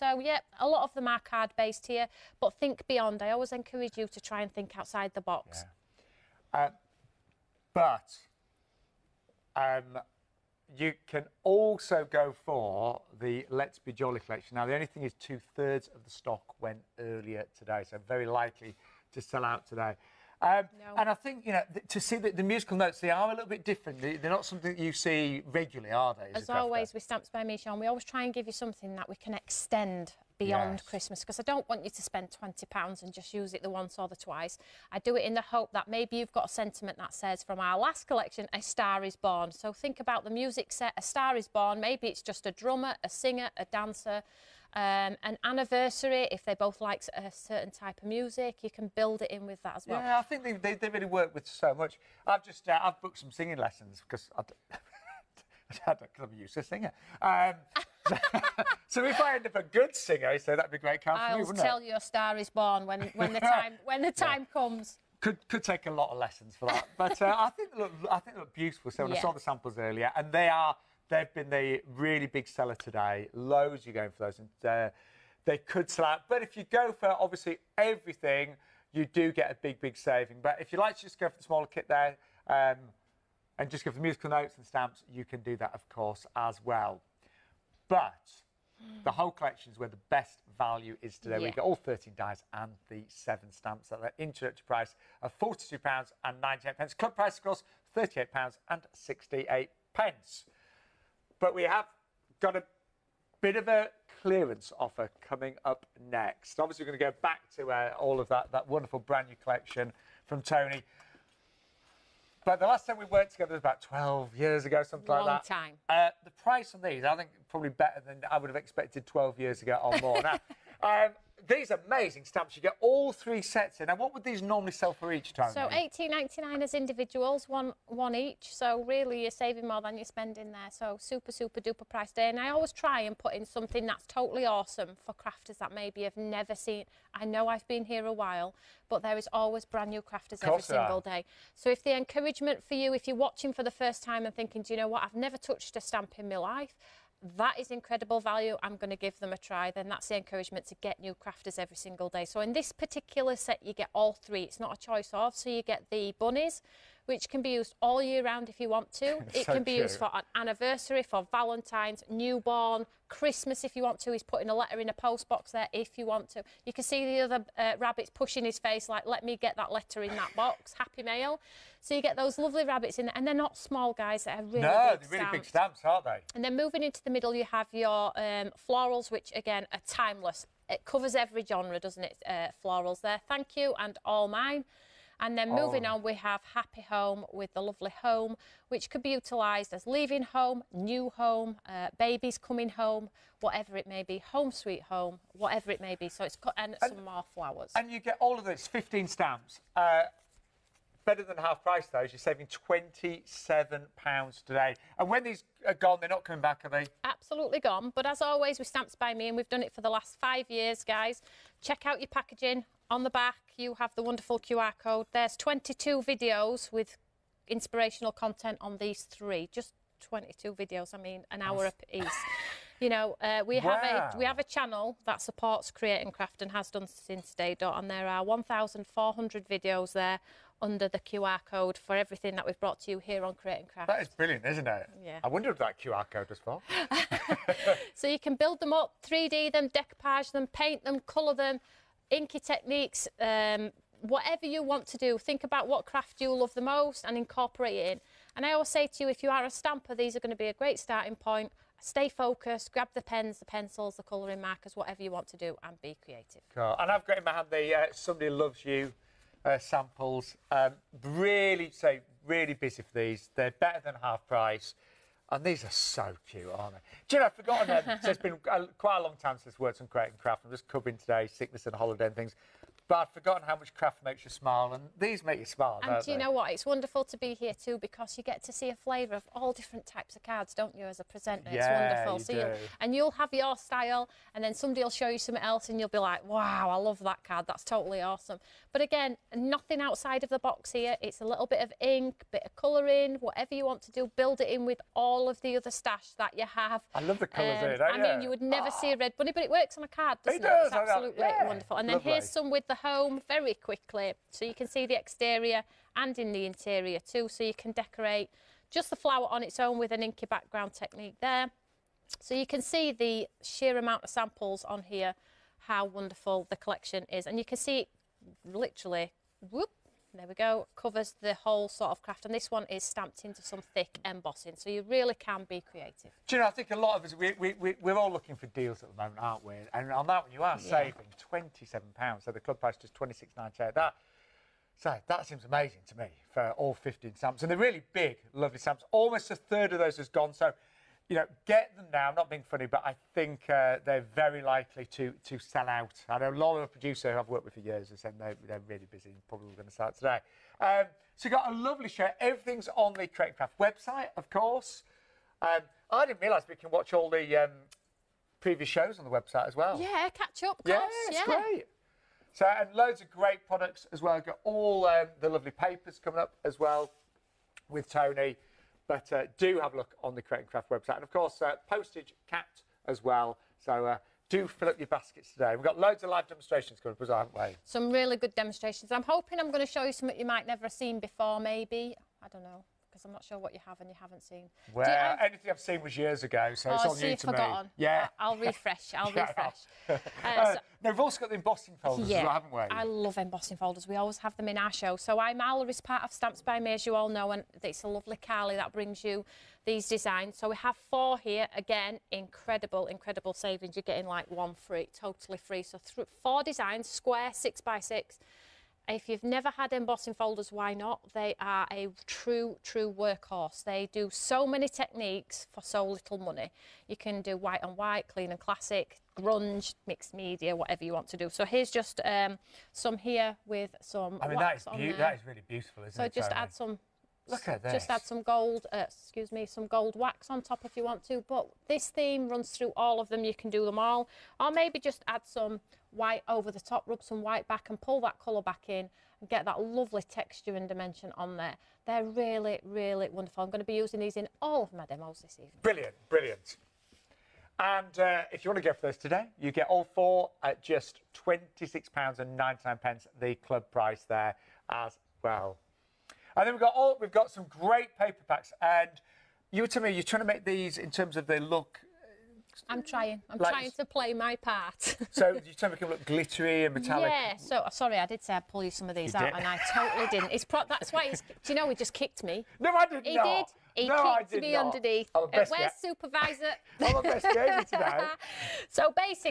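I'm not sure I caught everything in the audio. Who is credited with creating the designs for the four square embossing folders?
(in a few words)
Carly.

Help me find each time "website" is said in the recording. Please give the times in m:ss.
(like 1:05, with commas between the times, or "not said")
5:53, 5:59, 6:10.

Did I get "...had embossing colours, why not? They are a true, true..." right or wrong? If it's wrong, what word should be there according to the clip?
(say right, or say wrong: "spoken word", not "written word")
wrong: "folders", not "colours".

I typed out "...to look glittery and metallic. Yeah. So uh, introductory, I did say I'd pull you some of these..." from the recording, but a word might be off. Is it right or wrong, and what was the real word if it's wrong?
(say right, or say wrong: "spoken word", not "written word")
wrong: "sorry", not "introductory".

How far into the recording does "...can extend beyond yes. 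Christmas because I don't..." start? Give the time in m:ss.
0:29.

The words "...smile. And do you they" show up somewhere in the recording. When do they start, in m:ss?
4:35.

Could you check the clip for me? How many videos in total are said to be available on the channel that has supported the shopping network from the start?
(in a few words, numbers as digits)
1,400.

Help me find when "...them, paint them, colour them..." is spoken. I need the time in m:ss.
4:00.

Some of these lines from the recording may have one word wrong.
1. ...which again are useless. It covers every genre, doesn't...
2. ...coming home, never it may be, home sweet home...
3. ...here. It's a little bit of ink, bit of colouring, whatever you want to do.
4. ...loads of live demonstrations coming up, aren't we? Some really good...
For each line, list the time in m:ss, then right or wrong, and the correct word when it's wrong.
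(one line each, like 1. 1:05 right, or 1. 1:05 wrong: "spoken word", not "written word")
1. 2:59 wrong: "timeless", not "useless"
2. 3:12 wrong: "whatever", not "never"
3. 4:50 right
4. 6:15 right.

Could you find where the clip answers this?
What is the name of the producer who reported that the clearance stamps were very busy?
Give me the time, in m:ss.
5:46.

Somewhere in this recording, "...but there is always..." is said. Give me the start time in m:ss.
2:18.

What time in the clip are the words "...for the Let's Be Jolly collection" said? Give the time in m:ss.
0:12.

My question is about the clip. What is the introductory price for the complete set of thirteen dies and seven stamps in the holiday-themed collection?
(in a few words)
£42.98.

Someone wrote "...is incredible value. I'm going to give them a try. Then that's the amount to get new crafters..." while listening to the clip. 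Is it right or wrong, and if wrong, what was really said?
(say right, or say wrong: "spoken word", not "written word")
wrong: "encouragement", not "amount".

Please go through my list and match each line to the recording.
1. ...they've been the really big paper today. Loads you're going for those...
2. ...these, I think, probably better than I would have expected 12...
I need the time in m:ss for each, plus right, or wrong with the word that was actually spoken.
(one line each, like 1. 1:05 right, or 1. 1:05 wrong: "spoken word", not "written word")
1. 1:11 wrong: "seller", not "paper"
2. 1:56 right.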